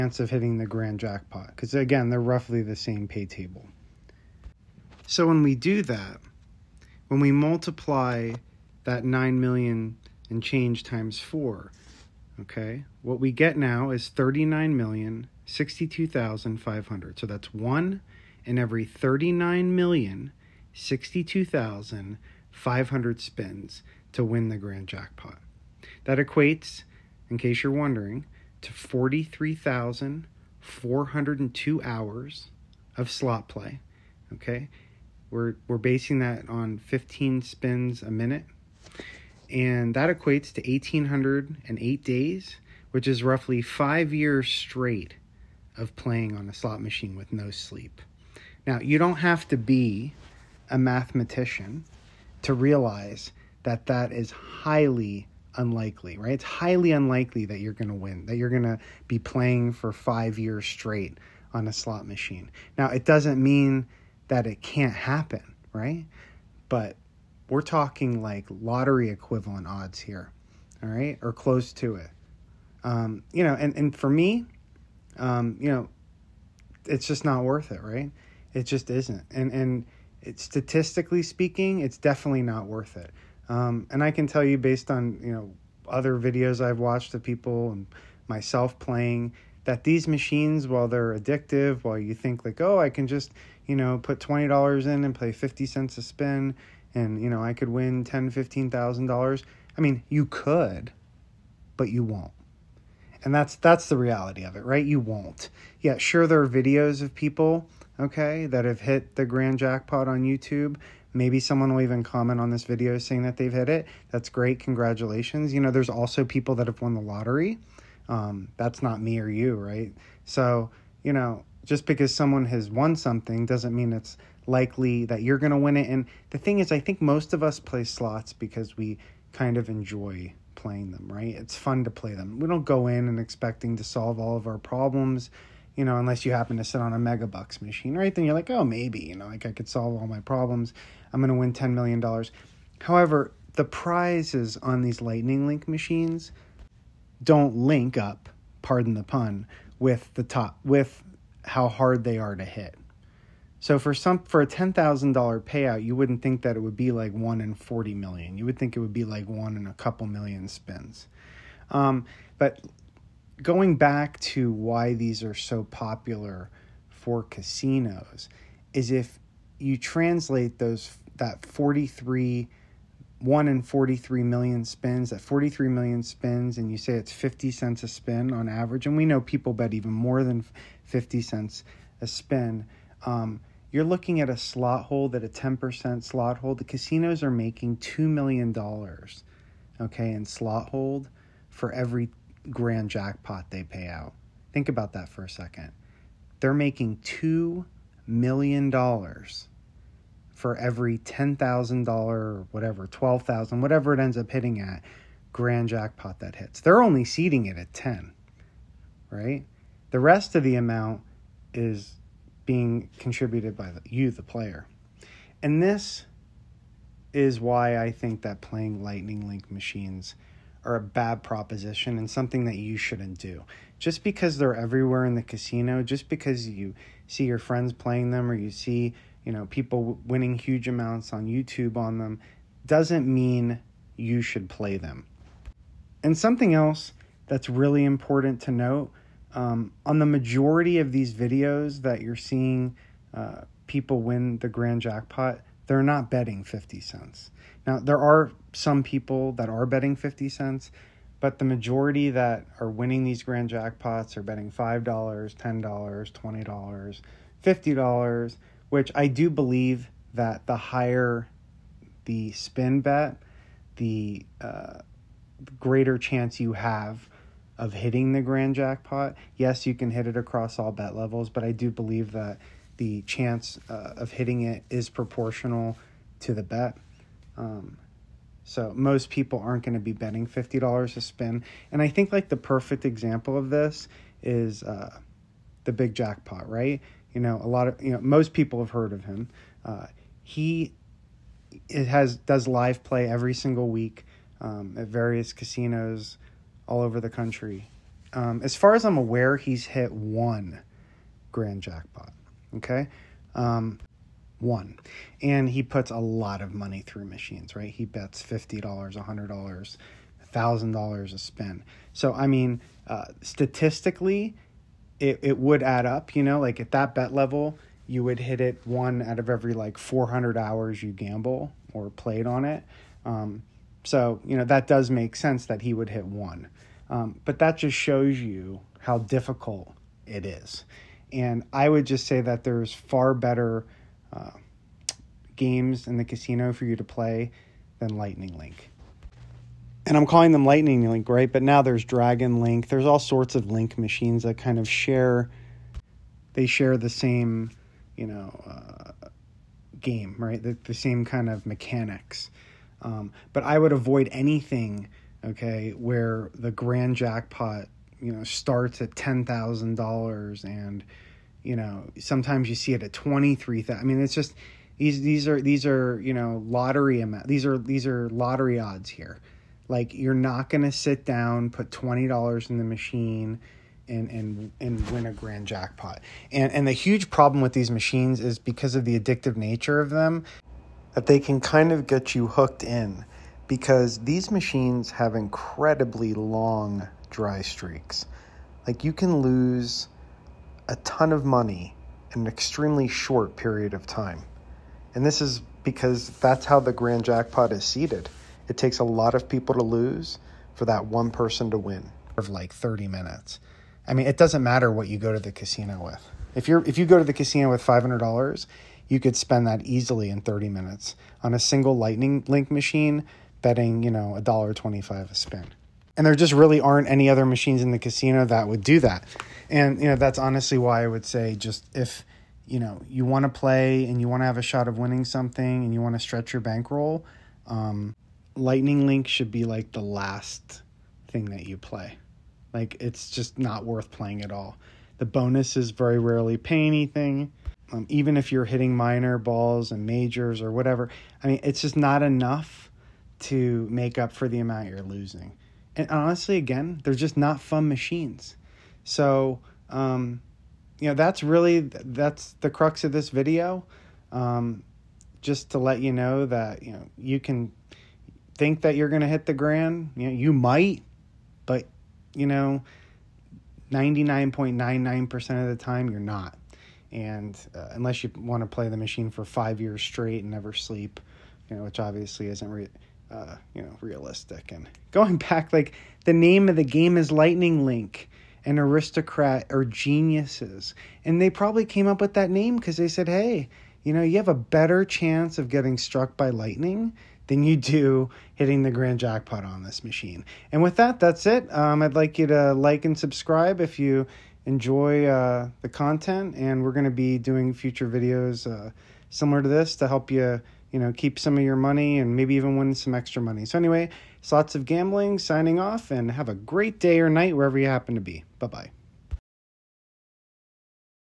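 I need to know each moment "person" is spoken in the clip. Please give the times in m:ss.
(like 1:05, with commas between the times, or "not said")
6:41.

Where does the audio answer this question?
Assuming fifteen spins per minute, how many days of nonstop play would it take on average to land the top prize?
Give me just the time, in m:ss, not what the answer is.
0:40.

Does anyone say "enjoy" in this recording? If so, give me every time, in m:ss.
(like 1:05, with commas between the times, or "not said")
2:09, 8:14.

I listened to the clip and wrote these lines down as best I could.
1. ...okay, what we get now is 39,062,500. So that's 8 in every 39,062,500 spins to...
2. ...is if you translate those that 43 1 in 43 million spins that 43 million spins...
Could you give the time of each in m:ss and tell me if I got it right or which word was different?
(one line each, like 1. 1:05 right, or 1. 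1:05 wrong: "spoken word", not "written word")
1. 0:12 wrong: "1", not "8"
2. 2:48 right.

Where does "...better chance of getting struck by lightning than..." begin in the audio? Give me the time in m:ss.
8:04.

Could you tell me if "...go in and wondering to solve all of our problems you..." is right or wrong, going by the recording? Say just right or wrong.
wrong.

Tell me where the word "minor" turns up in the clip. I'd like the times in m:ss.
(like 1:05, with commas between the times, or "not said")
7:18.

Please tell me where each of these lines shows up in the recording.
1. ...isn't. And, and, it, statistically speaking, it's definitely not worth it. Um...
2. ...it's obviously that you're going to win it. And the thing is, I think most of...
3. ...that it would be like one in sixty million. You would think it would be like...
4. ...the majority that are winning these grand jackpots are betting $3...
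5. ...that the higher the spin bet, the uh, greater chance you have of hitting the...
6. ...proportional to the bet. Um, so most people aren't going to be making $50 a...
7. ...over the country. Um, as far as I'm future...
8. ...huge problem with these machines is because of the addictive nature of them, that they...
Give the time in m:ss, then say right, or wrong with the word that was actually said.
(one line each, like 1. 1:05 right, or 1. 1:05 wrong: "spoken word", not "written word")
1. 1:18 right
2. 2:03 wrong: "likely", not "obviously"
3. 2:36 wrong: "forty", not "sixty"
4. 4:11 wrong: "5", not "3"
5. 4:20 right
6. 4:34 wrong: "betting", not "making"
7. 4:56 wrong: "aware", not "future"
8. 6:16 right.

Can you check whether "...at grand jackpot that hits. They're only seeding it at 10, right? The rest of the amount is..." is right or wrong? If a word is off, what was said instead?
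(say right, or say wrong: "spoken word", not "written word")
right.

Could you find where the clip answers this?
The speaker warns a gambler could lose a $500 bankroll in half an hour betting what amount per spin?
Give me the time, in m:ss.
6:54.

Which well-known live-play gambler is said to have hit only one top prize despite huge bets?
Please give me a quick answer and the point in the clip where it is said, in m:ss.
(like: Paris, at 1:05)
The Big Jackpot, at 4:45.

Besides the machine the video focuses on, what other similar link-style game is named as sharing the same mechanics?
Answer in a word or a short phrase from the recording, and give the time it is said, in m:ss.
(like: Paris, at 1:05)
Dragon Link, at 5:41.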